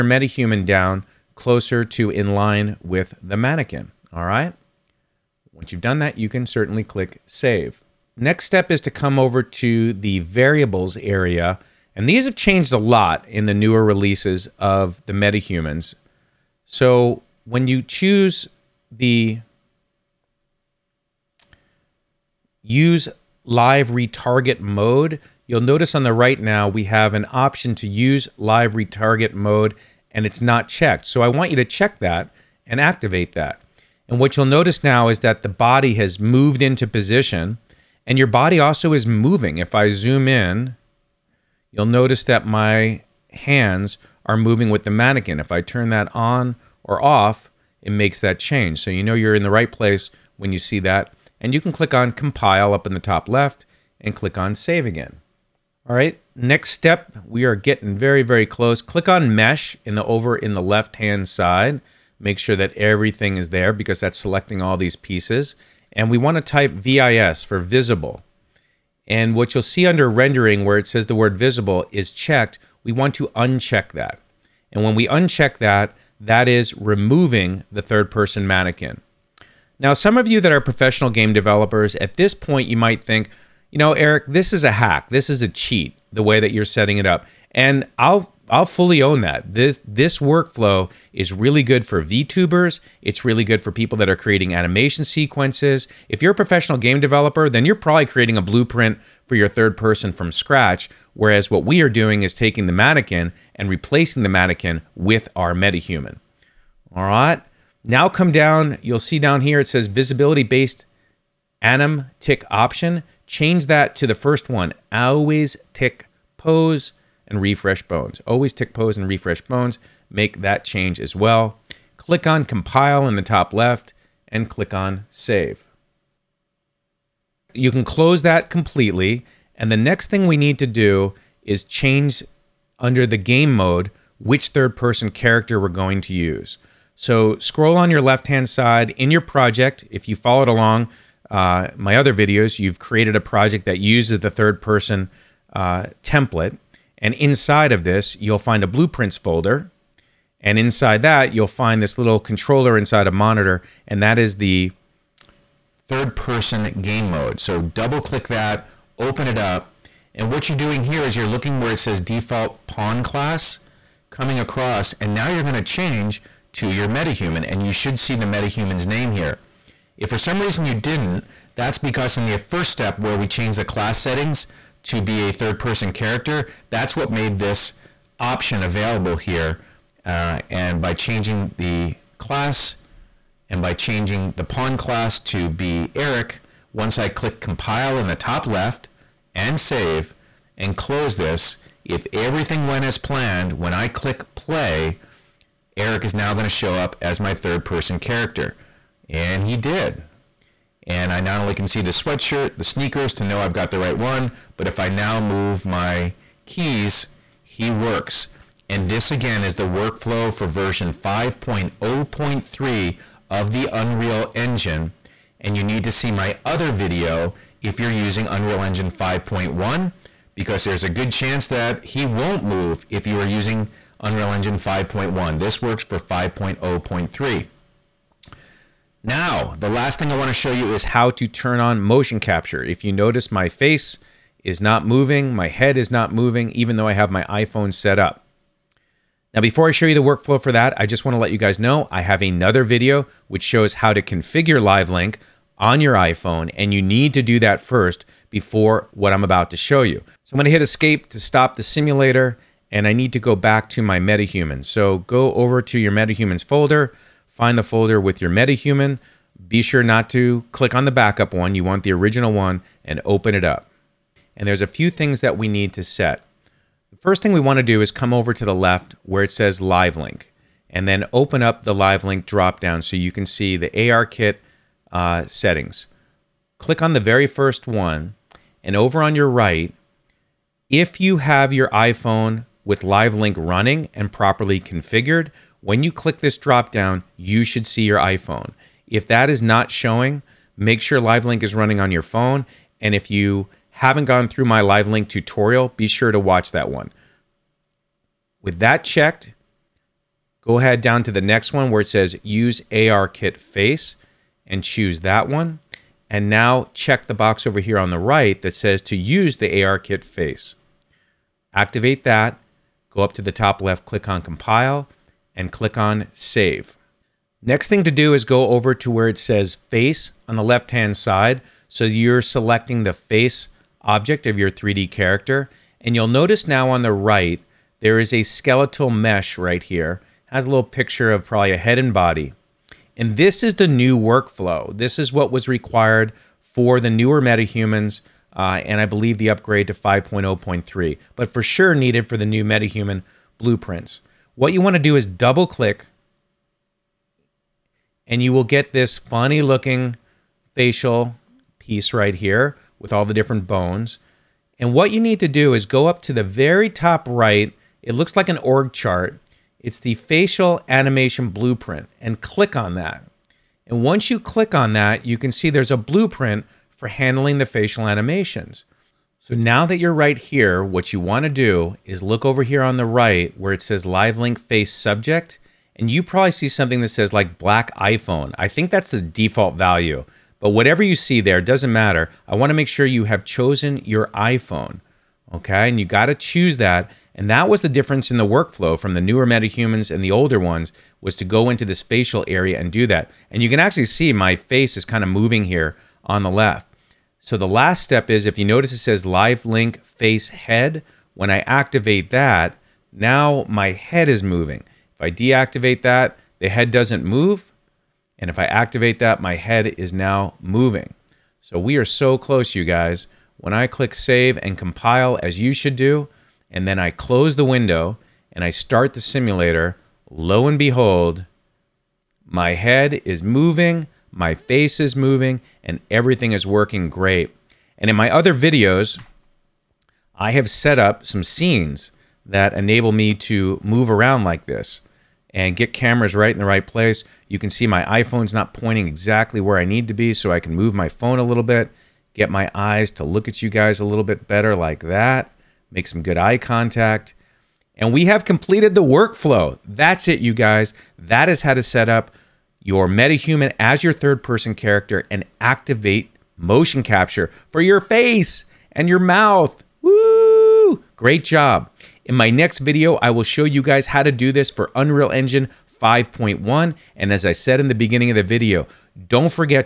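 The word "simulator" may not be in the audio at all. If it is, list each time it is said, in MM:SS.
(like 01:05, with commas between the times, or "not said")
04:11, 06:59.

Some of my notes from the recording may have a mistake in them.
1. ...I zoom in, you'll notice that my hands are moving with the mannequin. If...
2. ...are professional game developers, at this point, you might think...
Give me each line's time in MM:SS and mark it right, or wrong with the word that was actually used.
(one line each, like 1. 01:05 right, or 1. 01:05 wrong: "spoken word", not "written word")
1. 00:39 right
2. 01:20 right.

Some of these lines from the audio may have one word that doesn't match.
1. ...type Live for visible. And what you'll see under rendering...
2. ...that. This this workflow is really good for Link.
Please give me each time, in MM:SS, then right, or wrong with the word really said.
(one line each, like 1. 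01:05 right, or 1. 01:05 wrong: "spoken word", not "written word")
1. 01:06 wrong: "VIS", not "Live"
2. 01:29 wrong: "VTubers", not "Link".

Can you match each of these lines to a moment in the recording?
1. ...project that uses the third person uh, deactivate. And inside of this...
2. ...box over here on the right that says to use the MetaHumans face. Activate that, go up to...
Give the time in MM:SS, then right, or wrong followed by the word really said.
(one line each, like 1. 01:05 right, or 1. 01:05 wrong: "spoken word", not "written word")
1. 02:23 wrong: "template", not "deactivate"
2. 05:07 wrong: "ARKit", not "MetaHumans".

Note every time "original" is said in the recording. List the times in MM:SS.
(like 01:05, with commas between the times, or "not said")
04:21.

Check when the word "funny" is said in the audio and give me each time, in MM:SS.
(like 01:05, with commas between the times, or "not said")
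05:48.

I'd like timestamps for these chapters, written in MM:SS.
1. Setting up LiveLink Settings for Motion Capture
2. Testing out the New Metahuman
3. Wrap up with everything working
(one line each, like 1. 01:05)
1. 04:09
2. 03:17
3. 06:59.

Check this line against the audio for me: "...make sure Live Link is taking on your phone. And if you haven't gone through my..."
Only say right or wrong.
wrong.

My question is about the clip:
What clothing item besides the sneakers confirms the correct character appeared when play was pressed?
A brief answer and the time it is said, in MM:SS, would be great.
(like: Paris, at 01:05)
Sweatshirt, at 03:21.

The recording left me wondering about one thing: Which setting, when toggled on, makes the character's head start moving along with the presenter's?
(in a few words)
Live link face head.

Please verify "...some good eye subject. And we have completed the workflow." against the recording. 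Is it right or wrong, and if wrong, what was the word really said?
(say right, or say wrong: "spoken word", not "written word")
wrong: "contact", not "subject".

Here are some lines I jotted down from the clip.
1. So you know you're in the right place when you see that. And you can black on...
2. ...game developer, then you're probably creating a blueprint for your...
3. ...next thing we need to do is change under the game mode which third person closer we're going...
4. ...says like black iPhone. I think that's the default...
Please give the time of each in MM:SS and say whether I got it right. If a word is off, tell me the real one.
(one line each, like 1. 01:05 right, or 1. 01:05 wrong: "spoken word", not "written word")
1. 00:48 wrong: "click", not "black"
2. 01:36 right
3. 02:09 wrong: "character", not "closer"
4. 06:16 right.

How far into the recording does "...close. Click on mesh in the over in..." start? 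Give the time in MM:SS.
00:58.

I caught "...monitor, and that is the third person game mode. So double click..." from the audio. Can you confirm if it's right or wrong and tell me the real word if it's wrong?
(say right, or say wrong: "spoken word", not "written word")
right.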